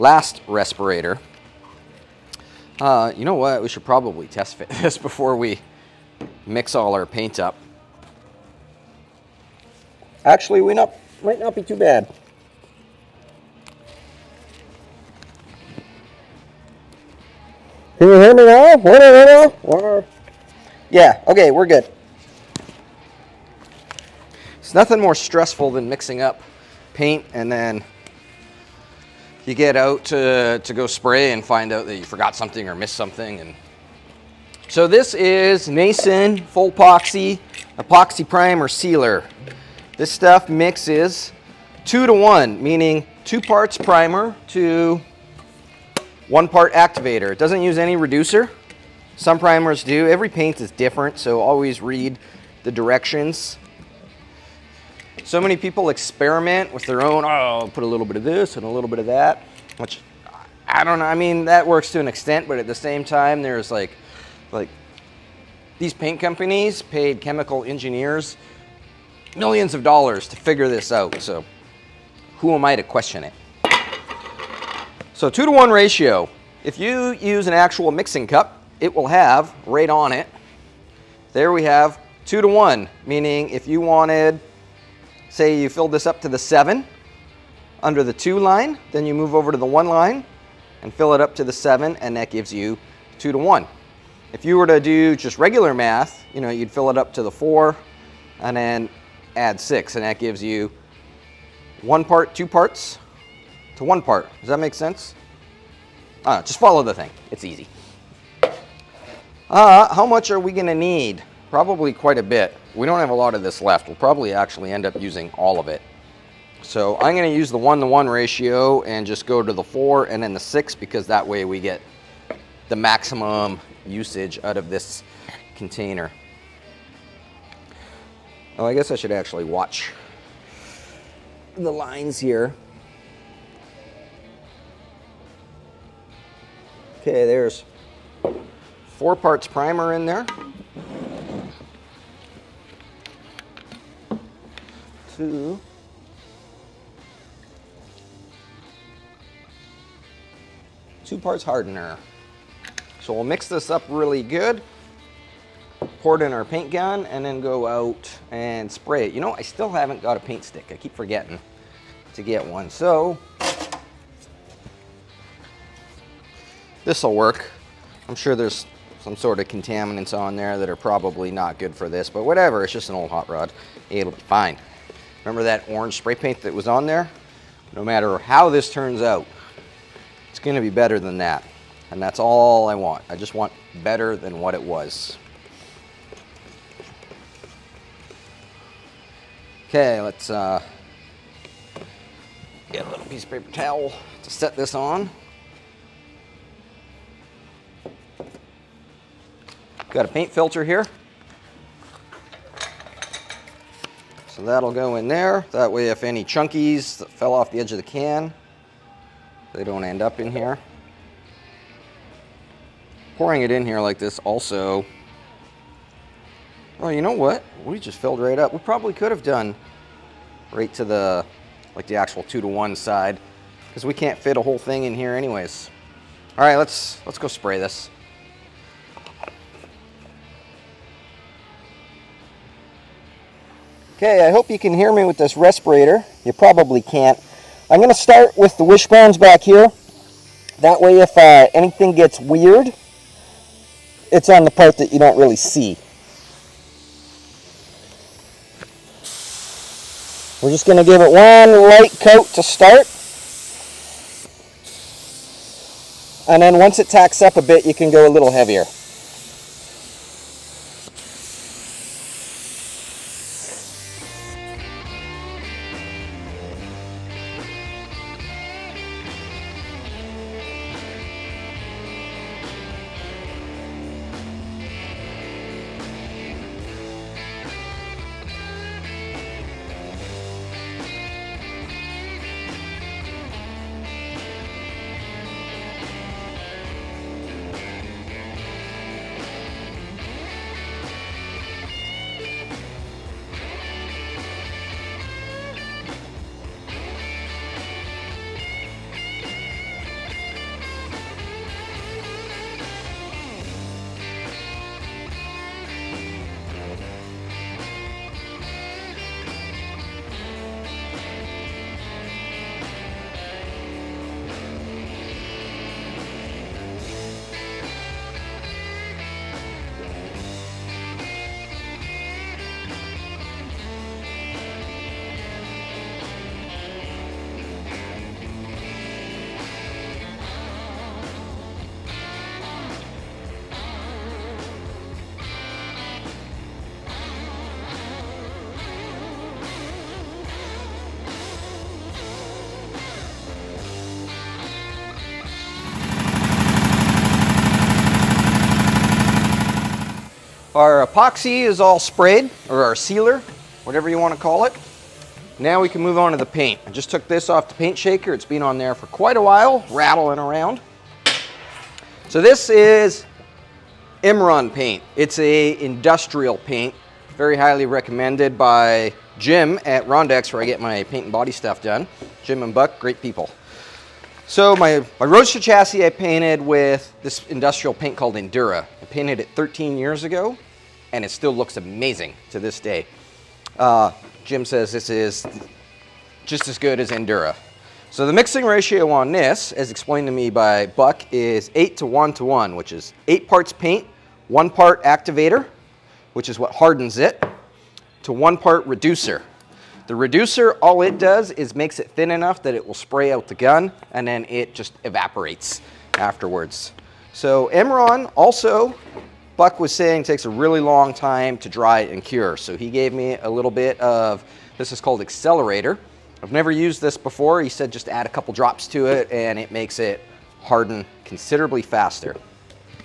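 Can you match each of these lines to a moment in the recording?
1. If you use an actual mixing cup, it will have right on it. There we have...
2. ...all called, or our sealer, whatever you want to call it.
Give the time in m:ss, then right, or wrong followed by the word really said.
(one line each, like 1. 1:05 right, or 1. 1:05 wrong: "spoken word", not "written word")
1. 1:16 right
2. 5:51 wrong: "sprayed", not "called".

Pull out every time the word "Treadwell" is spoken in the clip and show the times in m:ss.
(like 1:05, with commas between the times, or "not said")
not said.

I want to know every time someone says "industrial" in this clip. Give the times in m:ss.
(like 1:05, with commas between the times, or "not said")
6:05, 6:17.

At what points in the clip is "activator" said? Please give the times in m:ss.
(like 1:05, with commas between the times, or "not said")
0:46, 6:34.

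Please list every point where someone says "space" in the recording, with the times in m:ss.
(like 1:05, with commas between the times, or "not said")
not said.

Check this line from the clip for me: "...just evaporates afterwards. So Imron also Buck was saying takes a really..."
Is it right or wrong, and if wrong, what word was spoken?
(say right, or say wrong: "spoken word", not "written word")
right.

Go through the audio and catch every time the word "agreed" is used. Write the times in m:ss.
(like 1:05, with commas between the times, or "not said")
not said.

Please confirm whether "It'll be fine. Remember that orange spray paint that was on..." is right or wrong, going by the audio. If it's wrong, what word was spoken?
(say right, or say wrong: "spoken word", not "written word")
right.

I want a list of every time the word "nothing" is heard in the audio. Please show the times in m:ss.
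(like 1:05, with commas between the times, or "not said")
0:24.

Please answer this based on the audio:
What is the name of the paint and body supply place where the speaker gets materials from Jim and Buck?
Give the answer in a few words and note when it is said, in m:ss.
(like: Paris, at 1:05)
Rondex, at 6:09.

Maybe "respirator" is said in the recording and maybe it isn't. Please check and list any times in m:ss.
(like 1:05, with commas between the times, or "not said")
0:00, 3:55.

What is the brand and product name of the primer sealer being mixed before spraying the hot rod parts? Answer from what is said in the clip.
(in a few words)
Nason Full Epoxy.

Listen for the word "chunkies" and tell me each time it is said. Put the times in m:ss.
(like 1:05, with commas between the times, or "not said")
3:26.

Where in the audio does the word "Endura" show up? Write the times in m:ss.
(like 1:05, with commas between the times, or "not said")
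6:18, 6:26.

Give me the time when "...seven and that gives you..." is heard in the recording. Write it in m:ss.
1:31.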